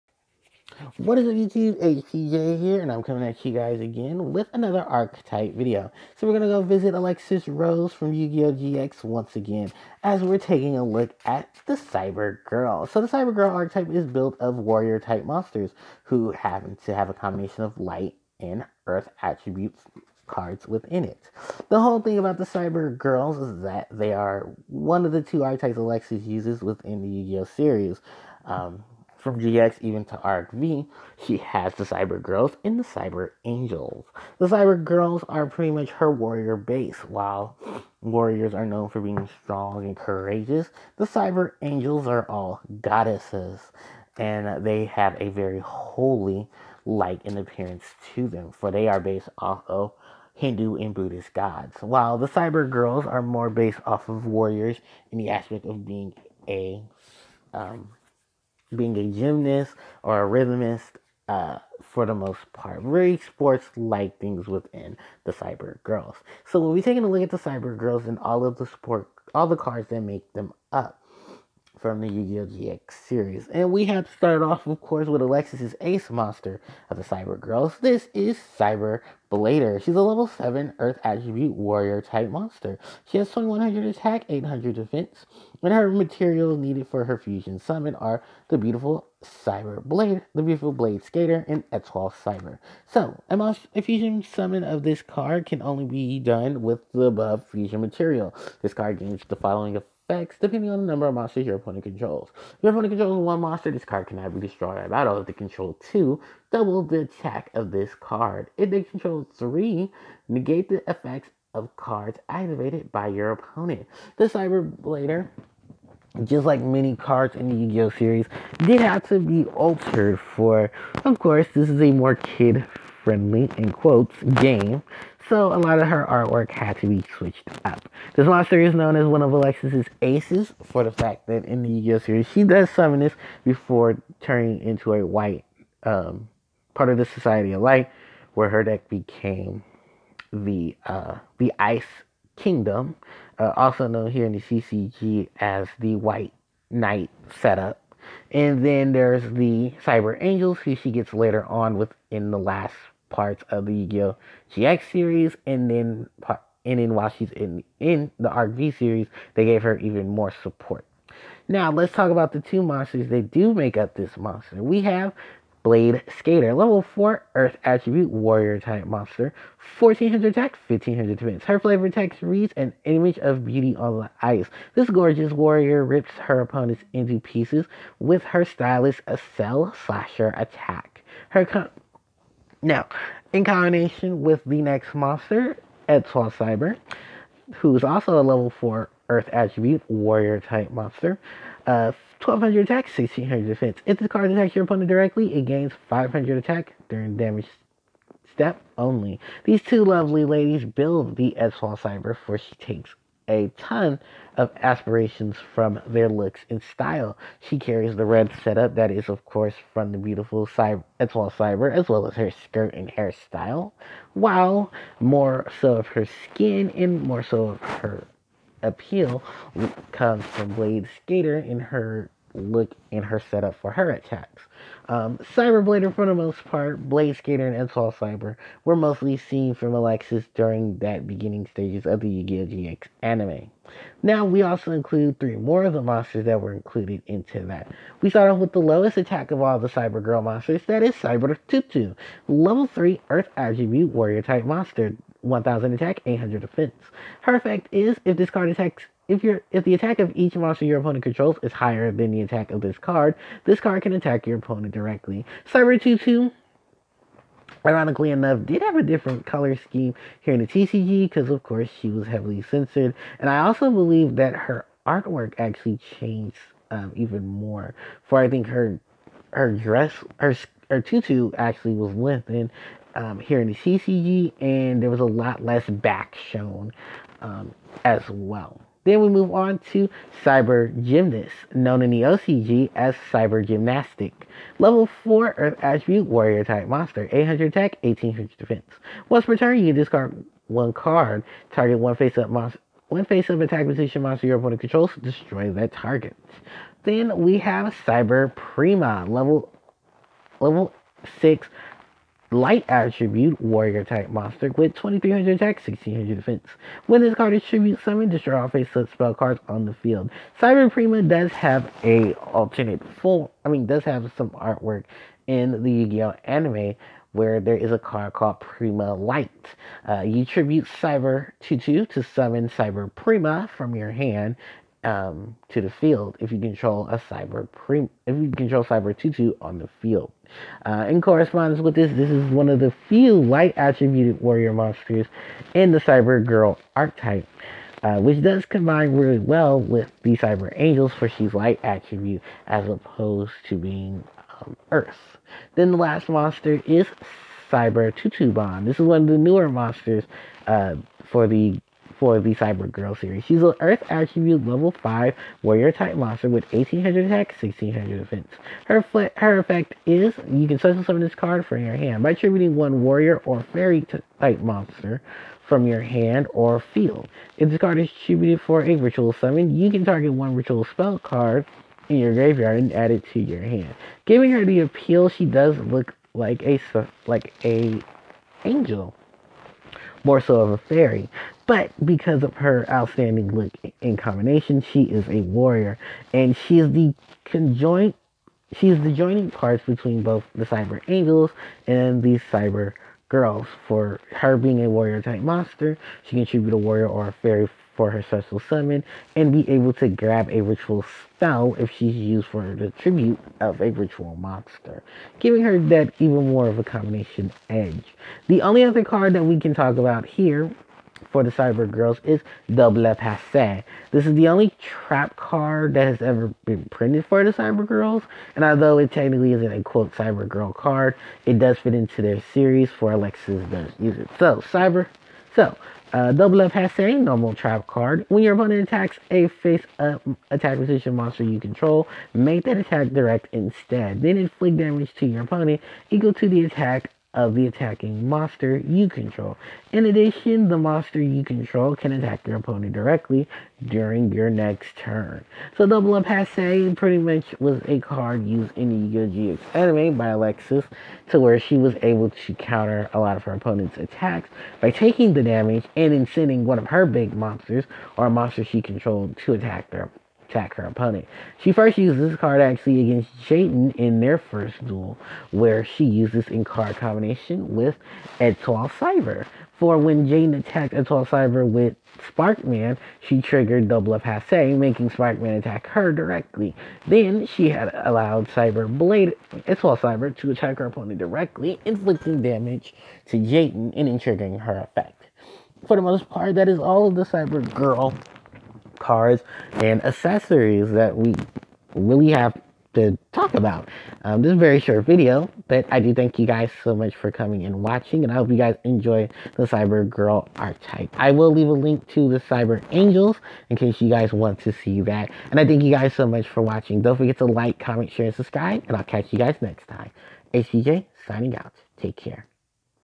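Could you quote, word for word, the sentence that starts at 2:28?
And then there's the Cyber Angels, who she gets later on within the last parts of the Yu-Gi-Oh!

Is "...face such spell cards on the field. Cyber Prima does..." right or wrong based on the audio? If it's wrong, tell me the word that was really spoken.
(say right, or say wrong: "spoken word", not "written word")
right.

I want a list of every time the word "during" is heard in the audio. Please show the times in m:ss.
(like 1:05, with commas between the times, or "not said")
3:16, 3:50, 7:23.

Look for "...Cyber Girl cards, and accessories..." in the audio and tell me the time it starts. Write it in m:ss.
8:07.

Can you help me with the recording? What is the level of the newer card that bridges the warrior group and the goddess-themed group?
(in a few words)
5.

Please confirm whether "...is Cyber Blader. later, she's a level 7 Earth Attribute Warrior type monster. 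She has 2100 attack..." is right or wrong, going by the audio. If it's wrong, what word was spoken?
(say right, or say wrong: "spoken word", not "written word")
right.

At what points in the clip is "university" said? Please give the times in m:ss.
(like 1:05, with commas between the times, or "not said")
not said.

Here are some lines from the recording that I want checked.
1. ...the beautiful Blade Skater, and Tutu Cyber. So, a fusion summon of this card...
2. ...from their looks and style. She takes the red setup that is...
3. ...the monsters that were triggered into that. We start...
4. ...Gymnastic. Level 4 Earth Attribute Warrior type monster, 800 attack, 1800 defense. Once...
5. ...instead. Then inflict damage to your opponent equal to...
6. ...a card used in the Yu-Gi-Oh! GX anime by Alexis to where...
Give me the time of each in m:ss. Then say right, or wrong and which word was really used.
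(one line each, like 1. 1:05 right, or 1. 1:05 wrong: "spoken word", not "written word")
1. 1:30 wrong: "Etoile", not "Tutu"
2. 3:25 wrong: "carries", not "takes"
3. 3:55 wrong: "included", not "triggered"
4. 4:43 right
5. 7:13 right
6. 7:27 right.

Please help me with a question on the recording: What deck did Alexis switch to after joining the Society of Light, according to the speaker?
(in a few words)
Ice Kingdom.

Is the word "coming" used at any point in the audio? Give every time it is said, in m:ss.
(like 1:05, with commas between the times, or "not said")
0:03, 8:17.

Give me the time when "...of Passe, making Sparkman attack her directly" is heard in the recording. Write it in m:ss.
7:53.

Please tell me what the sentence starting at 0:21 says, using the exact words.
The whole thing about the Cyber Girls is that they are one of the two archetypes Alexis uses within the Yu-Gi-Oh series.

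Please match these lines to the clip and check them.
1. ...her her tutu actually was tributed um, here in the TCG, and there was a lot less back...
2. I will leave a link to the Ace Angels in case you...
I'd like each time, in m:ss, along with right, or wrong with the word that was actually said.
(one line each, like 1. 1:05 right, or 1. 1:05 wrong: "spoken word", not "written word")
1. 4:30 wrong: "lengthened", not "tributed"
2. 8:20 wrong: "Cyber", not "Ace".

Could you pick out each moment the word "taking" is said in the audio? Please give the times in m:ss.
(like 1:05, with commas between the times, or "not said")
0:10, 1:06, 7:34.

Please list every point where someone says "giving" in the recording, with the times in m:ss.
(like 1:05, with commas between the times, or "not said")
6:14, 6:45.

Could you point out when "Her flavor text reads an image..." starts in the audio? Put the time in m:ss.
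2:51.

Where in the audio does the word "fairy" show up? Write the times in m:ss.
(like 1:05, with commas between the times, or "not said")
6:03, 6:20, 6:37.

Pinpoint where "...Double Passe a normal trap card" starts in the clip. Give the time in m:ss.
7:06.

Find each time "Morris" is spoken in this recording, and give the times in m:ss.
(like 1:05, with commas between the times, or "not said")
not said.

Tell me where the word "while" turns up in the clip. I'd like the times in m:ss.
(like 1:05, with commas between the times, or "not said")
0:37, 0:51, 2:36, 3:34.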